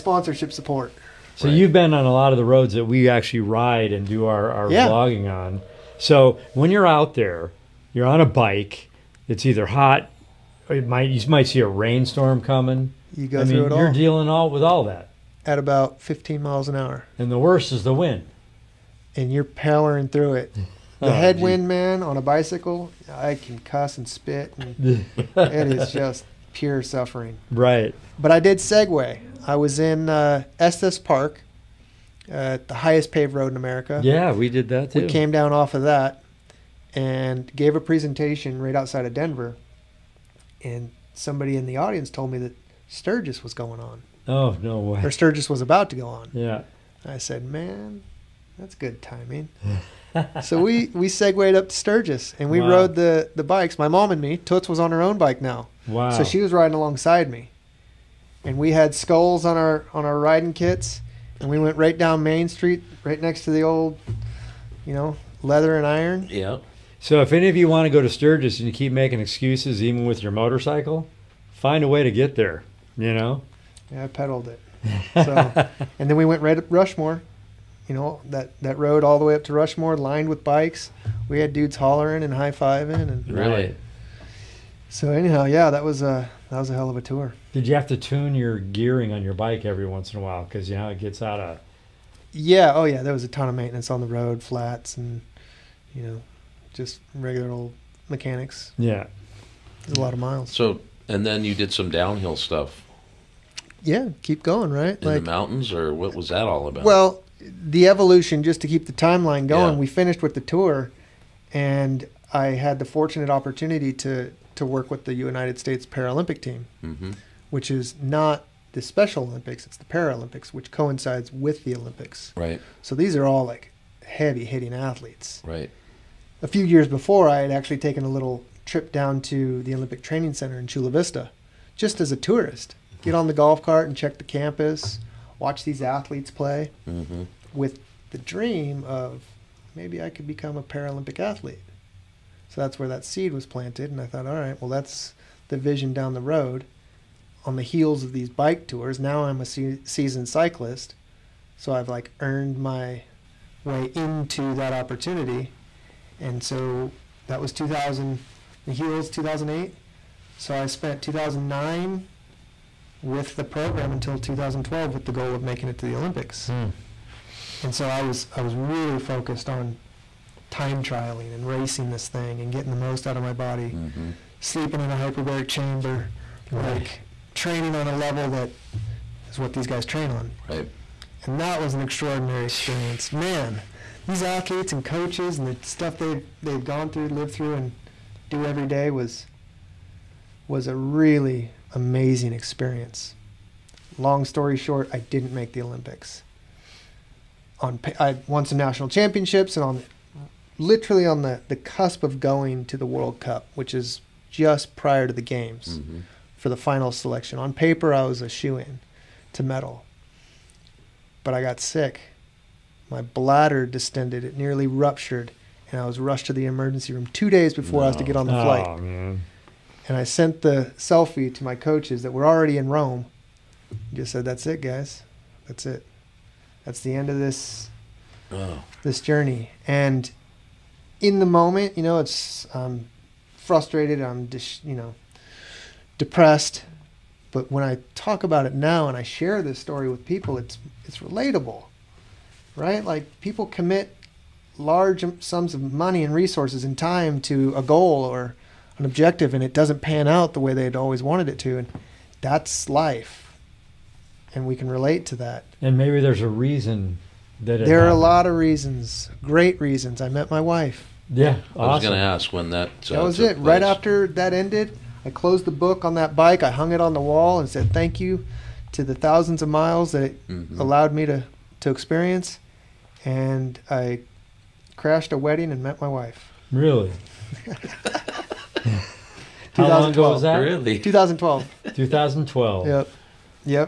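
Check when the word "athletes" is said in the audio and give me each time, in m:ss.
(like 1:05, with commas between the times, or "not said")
2:04, 2:15, 2:21, 3:04.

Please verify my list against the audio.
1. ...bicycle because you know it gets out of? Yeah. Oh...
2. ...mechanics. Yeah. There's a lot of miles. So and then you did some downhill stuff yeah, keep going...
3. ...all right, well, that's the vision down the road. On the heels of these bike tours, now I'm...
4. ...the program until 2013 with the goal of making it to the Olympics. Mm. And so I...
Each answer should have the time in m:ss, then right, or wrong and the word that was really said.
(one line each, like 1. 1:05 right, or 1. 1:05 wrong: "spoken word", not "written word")
1. 1:30 wrong: "while", not "bicycle"
2. 1:38 right
3. 2:24 right
4. 2:43 wrong: "2012", not "2013".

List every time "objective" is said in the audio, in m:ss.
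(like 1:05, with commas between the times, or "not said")
4:08.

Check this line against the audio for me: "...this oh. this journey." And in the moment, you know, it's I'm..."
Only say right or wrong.
right.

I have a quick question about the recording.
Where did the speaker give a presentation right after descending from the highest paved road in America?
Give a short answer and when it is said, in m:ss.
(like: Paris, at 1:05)
Outside of Denver, at 0:38.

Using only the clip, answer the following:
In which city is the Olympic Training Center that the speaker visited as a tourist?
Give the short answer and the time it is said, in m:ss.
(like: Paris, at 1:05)
Chula Vista, at 2:10.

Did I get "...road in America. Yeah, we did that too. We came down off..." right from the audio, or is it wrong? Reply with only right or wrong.
right.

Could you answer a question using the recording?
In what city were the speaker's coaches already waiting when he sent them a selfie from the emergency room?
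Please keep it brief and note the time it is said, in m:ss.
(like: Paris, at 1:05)
Rome, at 3:42.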